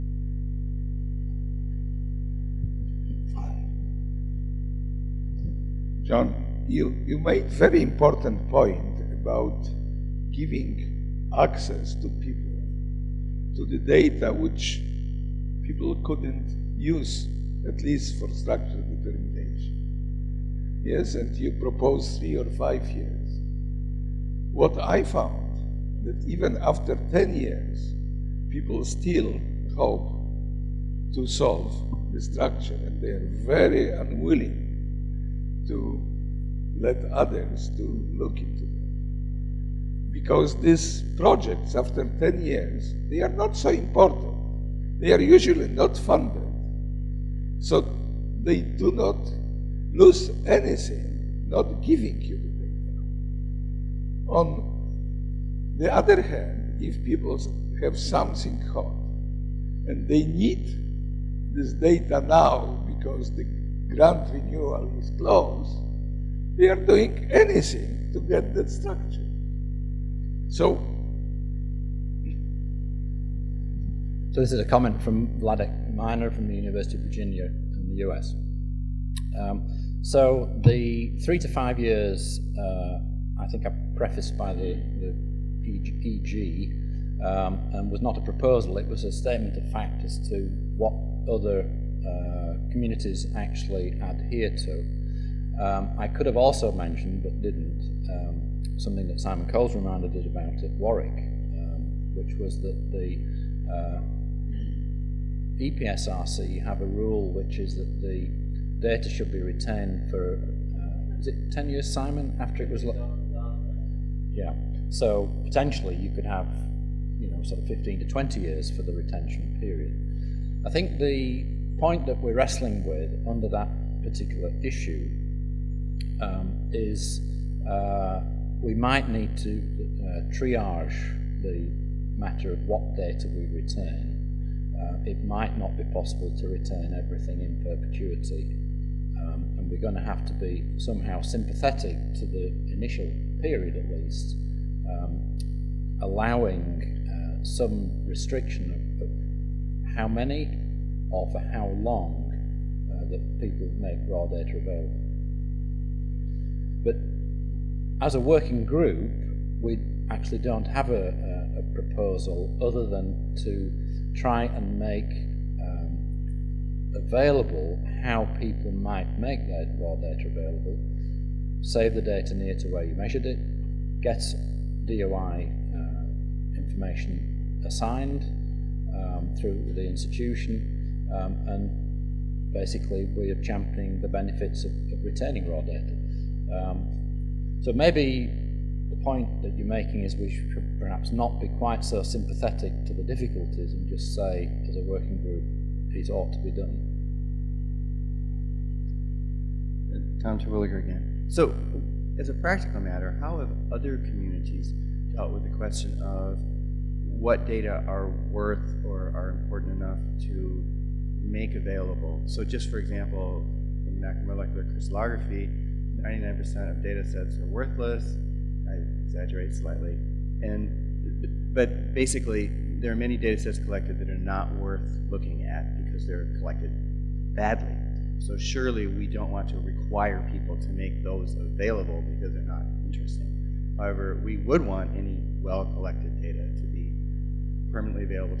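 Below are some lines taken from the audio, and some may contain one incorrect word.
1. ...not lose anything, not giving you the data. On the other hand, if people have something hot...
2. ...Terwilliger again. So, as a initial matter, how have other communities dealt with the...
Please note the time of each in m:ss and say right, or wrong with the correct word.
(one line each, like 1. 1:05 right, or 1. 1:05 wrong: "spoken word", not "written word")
1. 0:48 right
2. 3:20 wrong: "practical", not "initial".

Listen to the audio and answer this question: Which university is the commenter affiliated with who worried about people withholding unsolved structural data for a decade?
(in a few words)
University of Virginia.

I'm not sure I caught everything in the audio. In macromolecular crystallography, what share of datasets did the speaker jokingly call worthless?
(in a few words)
99%.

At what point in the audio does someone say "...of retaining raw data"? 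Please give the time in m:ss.
3:04.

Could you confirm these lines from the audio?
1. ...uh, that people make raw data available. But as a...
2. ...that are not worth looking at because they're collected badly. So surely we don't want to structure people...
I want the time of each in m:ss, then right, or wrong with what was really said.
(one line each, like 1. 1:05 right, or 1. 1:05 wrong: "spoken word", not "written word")
1. 2:32 right
2. 3:43 wrong: "require", not "structure".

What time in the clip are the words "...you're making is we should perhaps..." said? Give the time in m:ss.
3:09.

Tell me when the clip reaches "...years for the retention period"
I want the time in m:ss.
1:58.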